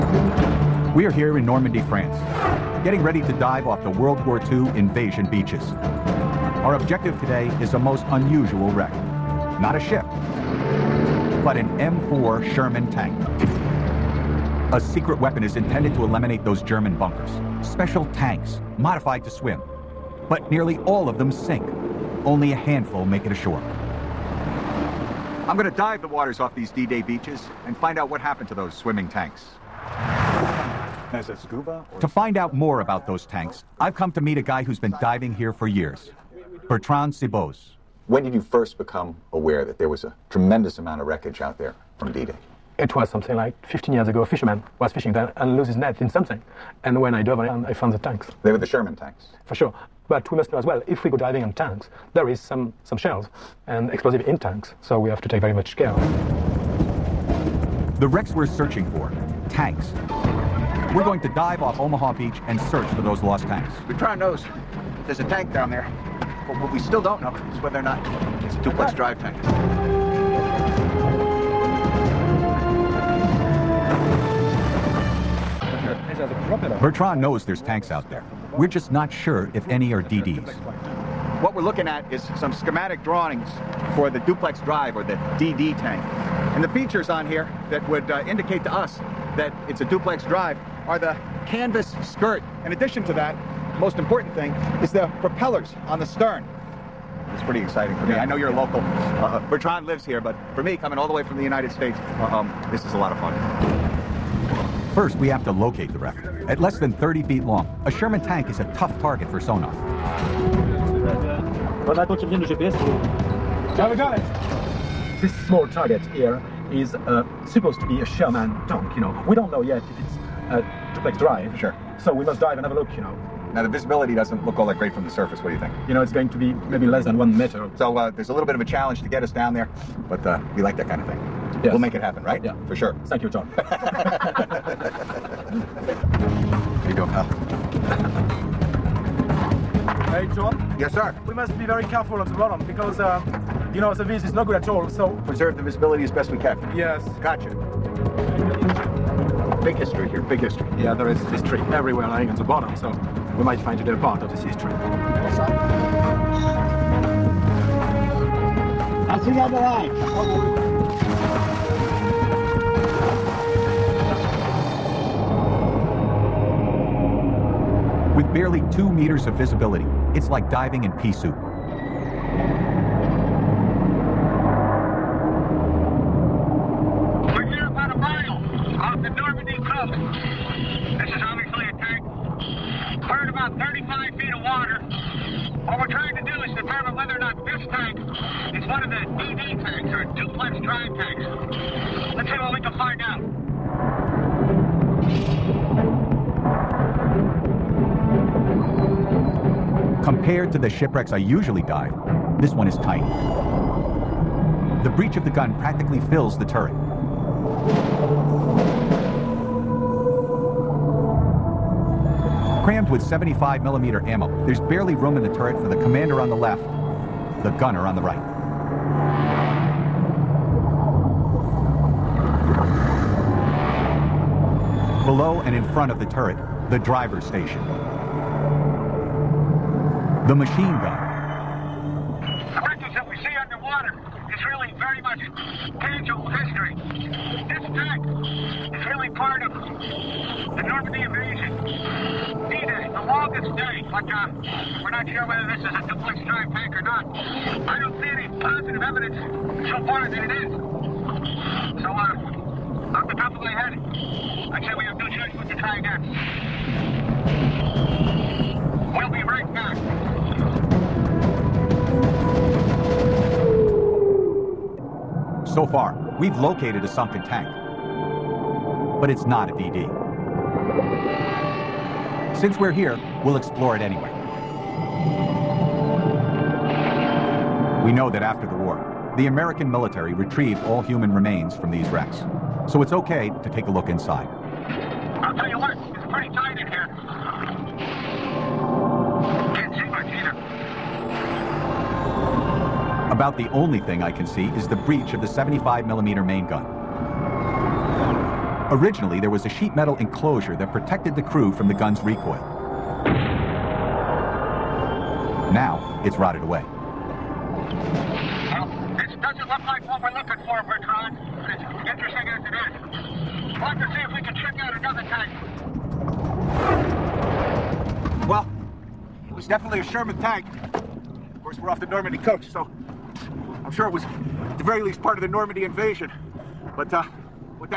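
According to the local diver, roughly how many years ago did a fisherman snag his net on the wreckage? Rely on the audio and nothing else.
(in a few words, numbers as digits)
15 years.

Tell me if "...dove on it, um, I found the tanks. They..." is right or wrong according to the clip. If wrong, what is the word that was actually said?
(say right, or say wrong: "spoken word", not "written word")
right.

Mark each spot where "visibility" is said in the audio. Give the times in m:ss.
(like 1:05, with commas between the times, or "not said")
2:03, 2:25.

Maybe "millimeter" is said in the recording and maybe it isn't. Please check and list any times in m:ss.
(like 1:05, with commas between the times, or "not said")
3:33, 4:55.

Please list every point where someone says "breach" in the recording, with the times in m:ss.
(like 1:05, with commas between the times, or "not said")
3:24.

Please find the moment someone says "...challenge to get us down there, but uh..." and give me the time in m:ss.
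2:08.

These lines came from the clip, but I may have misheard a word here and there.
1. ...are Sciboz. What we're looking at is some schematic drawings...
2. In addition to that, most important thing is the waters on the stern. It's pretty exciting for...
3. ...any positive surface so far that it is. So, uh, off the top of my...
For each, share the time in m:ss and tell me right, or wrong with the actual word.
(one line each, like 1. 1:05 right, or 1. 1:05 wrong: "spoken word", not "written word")
1. 1:19 wrong: "DDs", not "Sciboz"
2. 1:32 wrong: "propellers", not "waters"
3. 4:08 wrong: "evidence", not "surface".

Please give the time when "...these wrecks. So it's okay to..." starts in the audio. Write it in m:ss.
4:41.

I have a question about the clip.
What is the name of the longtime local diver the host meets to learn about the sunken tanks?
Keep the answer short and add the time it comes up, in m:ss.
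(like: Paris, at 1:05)
Bertrand Sciboz, at 0:36.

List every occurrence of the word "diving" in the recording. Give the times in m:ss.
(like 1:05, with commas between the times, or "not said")
0:35, 0:51.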